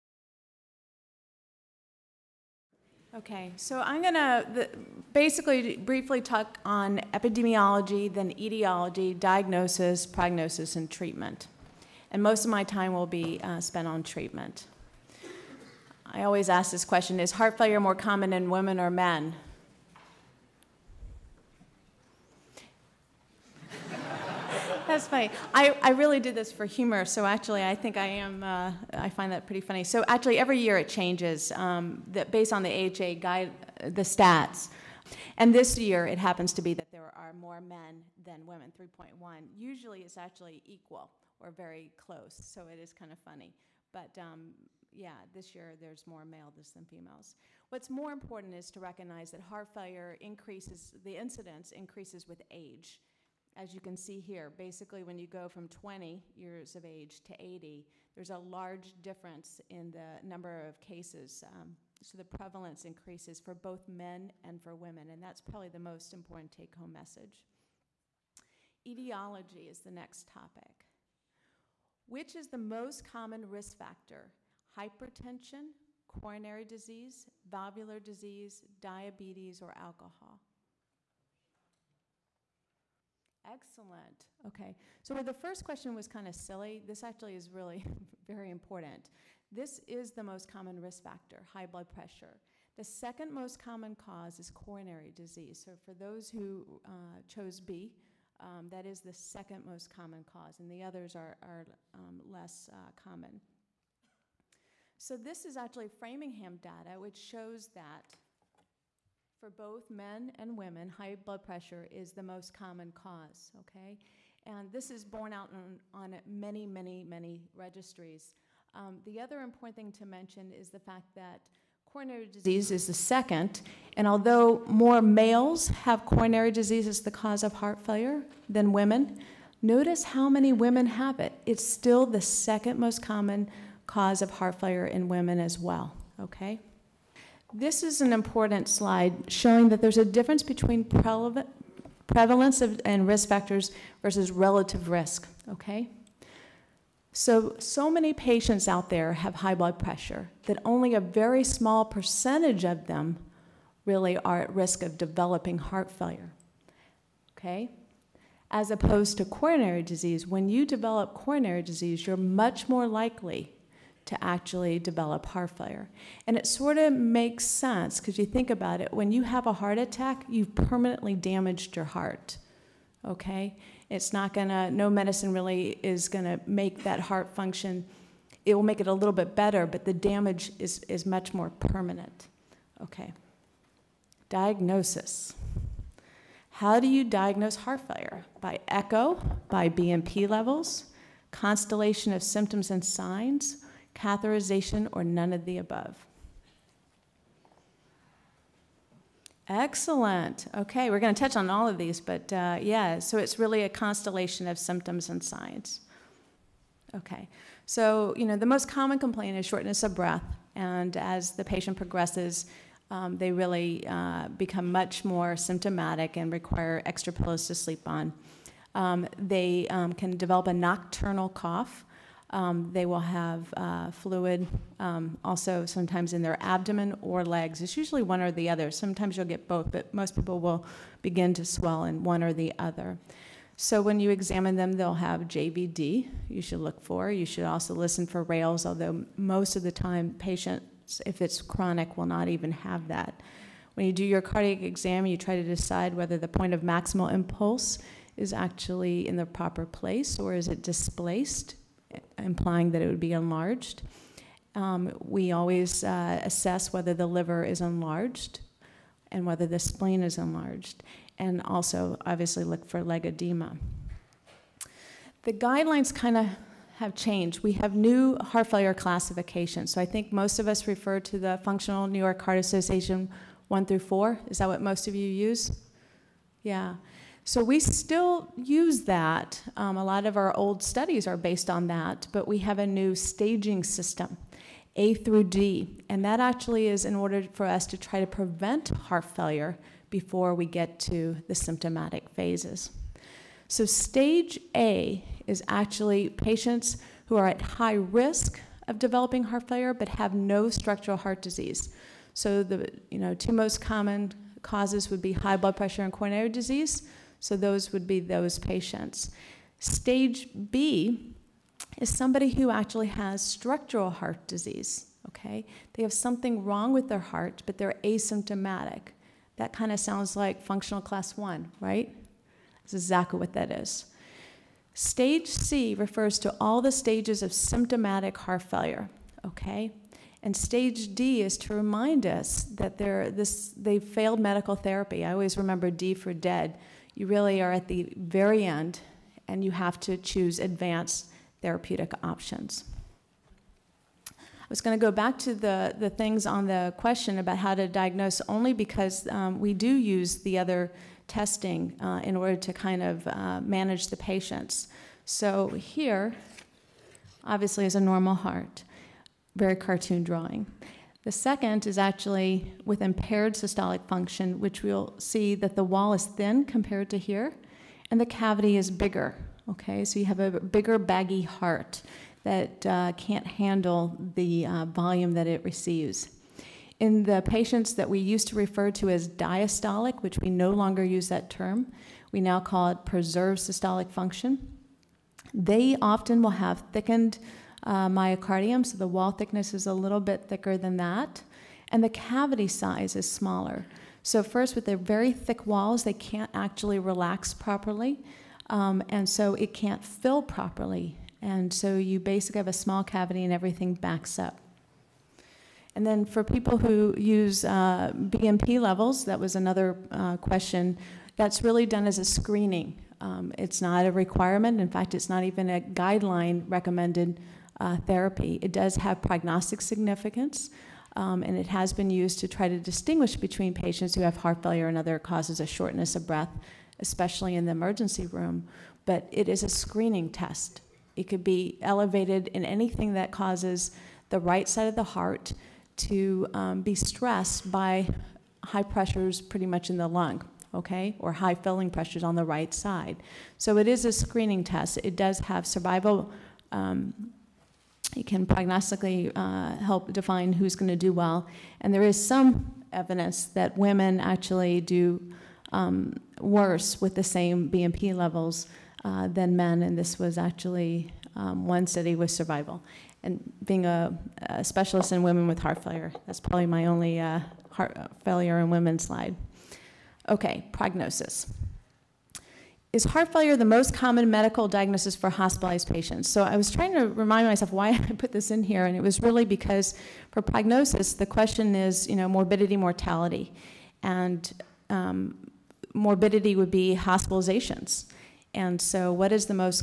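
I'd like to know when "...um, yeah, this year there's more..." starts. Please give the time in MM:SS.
00:44.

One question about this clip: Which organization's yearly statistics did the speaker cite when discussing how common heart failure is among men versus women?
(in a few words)
AHA.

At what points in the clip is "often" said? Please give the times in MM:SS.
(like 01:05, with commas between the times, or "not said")
06:25.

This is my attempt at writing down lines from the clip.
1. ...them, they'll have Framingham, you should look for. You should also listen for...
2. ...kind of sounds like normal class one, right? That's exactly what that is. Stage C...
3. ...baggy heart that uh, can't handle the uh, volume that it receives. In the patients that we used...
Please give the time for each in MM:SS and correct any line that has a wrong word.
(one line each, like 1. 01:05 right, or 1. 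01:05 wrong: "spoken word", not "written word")
1. 03:54 wrong: "JVD", not "Framingham"
2. 05:19 wrong: "functional", not "normal"
3. 06:10 right.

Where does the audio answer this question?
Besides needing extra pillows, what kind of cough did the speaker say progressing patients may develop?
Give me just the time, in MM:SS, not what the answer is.
03:40.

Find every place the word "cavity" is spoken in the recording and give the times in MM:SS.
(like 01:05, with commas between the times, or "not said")
06:08, 06:31, 06:42.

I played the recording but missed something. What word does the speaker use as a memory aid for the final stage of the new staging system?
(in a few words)
Dead.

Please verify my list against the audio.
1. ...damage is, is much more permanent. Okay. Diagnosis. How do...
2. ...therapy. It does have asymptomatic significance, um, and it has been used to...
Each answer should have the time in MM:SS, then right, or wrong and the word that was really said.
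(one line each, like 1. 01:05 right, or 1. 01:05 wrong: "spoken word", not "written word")
1. 02:59 right
2. 06:57 wrong: "prognostic", not "asymptomatic".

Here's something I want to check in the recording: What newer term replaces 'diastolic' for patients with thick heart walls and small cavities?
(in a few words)
Preserved systolic function.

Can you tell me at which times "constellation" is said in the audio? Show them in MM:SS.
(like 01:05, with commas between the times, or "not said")
03:11, 03:23.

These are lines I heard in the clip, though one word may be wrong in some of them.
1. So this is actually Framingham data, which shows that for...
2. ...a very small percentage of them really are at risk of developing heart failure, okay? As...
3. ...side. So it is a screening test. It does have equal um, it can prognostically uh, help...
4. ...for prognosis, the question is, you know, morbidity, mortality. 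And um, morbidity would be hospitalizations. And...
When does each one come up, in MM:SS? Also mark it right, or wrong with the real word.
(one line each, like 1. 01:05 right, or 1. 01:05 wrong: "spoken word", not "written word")
1. 01:44 right
2. 02:30 right
3. 07:22 wrong: "survival", not "equal"
4. 08:00 right.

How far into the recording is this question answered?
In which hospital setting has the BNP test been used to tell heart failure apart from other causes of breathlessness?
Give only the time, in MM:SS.
07:07.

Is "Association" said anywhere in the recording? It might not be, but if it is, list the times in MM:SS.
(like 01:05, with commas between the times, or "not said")
04:32.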